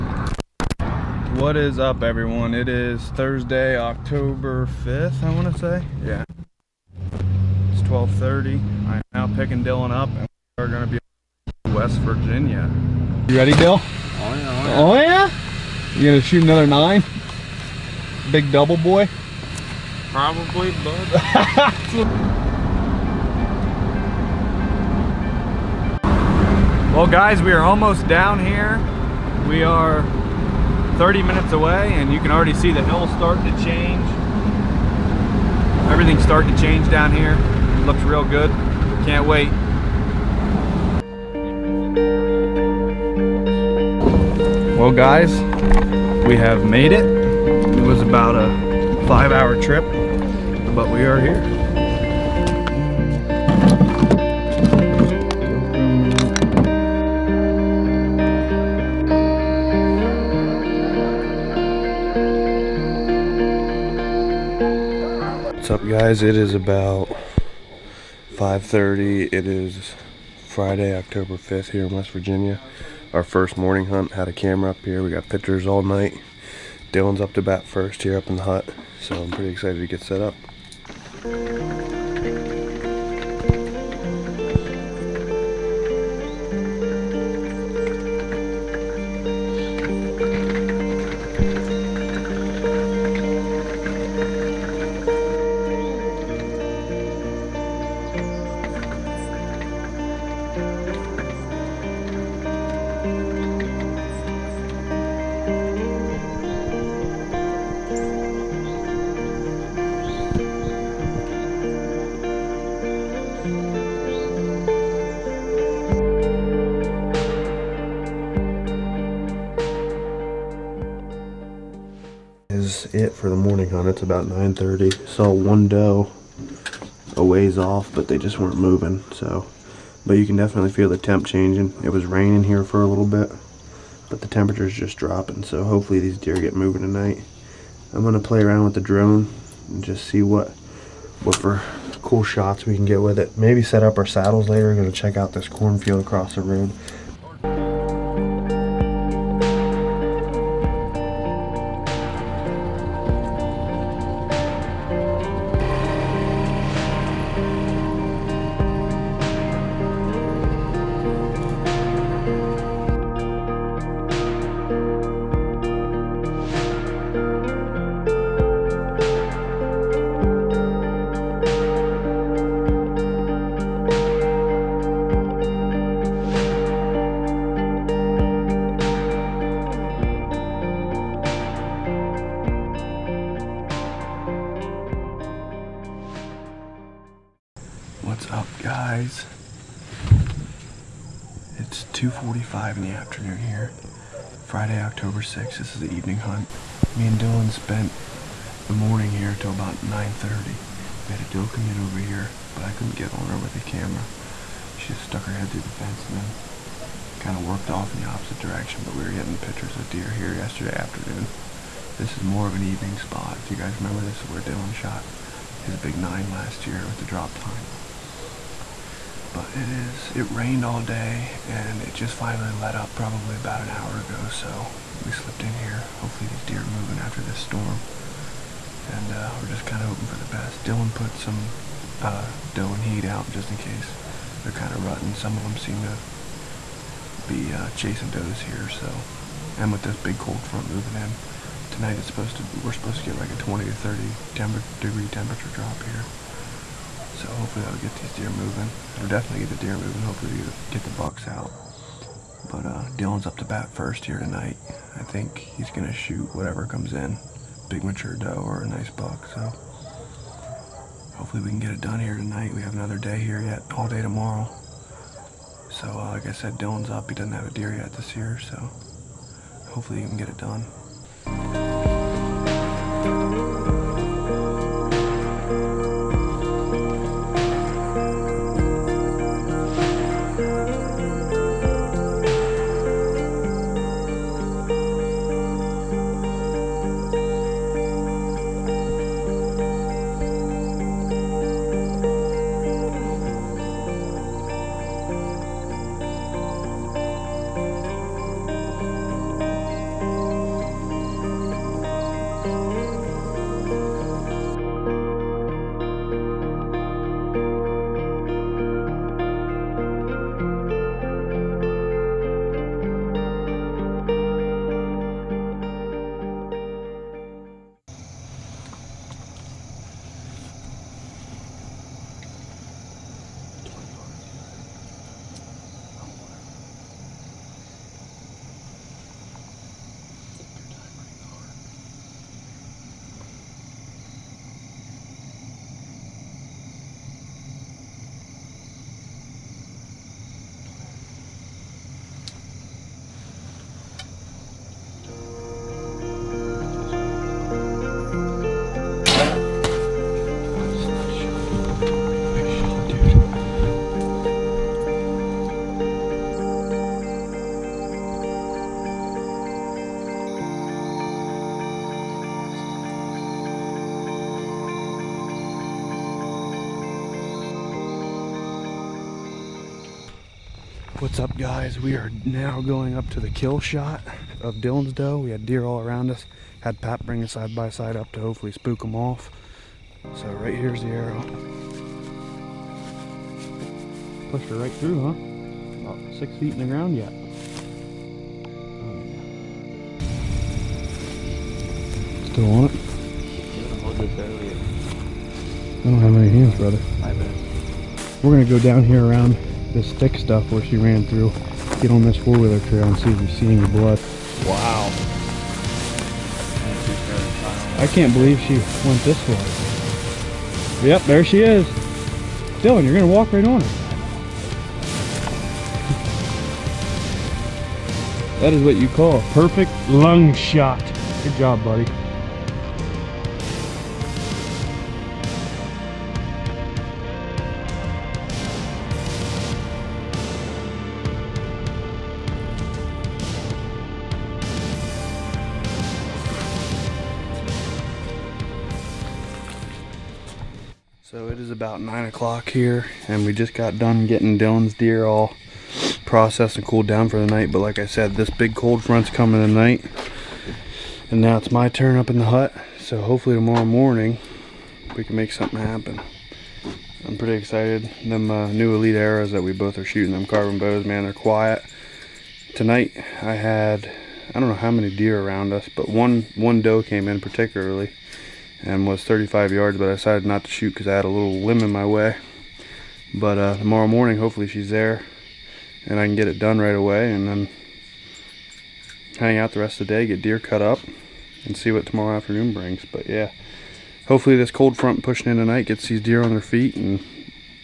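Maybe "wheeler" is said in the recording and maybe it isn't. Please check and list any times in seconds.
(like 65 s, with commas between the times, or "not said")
402 s.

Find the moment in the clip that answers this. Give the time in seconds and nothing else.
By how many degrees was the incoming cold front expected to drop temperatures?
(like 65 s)
243 s.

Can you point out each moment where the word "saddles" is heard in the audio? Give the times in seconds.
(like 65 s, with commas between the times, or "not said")
144 s.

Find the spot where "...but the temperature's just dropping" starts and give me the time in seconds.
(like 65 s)
134 s.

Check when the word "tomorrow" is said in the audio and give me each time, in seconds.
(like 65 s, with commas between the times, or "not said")
264 s, 453 s, 473 s, 481 s.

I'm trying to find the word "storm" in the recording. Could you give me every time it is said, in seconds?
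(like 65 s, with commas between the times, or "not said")
227 s.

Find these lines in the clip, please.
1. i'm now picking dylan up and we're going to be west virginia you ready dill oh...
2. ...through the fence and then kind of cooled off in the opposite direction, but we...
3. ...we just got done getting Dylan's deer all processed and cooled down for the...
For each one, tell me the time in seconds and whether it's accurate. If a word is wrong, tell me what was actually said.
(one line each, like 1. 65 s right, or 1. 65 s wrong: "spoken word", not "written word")
1. 8 s right
2. 205 s wrong: "worked", not "cooled"
3. 443 s right.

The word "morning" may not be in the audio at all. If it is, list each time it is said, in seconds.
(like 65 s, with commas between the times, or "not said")
73 s, 123 s, 198 s, 453 s, 473 s.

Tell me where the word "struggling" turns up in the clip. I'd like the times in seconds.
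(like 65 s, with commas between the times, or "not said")
not said.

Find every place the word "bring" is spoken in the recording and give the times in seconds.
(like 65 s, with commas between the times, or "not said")
377 s, 482 s.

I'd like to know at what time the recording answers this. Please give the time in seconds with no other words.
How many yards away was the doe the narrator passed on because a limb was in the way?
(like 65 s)
469 s.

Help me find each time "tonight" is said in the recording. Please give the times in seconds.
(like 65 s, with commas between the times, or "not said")
136 s, 241 s, 254 s, 262 s, 449 s, 462 s, 485 s.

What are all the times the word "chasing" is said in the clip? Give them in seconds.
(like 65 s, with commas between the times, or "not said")
237 s.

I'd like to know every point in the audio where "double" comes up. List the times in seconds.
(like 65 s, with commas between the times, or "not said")
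18 s.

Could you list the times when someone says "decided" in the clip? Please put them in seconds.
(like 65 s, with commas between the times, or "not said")
469 s.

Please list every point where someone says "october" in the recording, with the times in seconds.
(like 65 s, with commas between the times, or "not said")
3 s, 70 s, 194 s.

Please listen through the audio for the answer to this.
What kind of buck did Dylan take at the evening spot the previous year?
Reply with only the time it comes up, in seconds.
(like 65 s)
215 s.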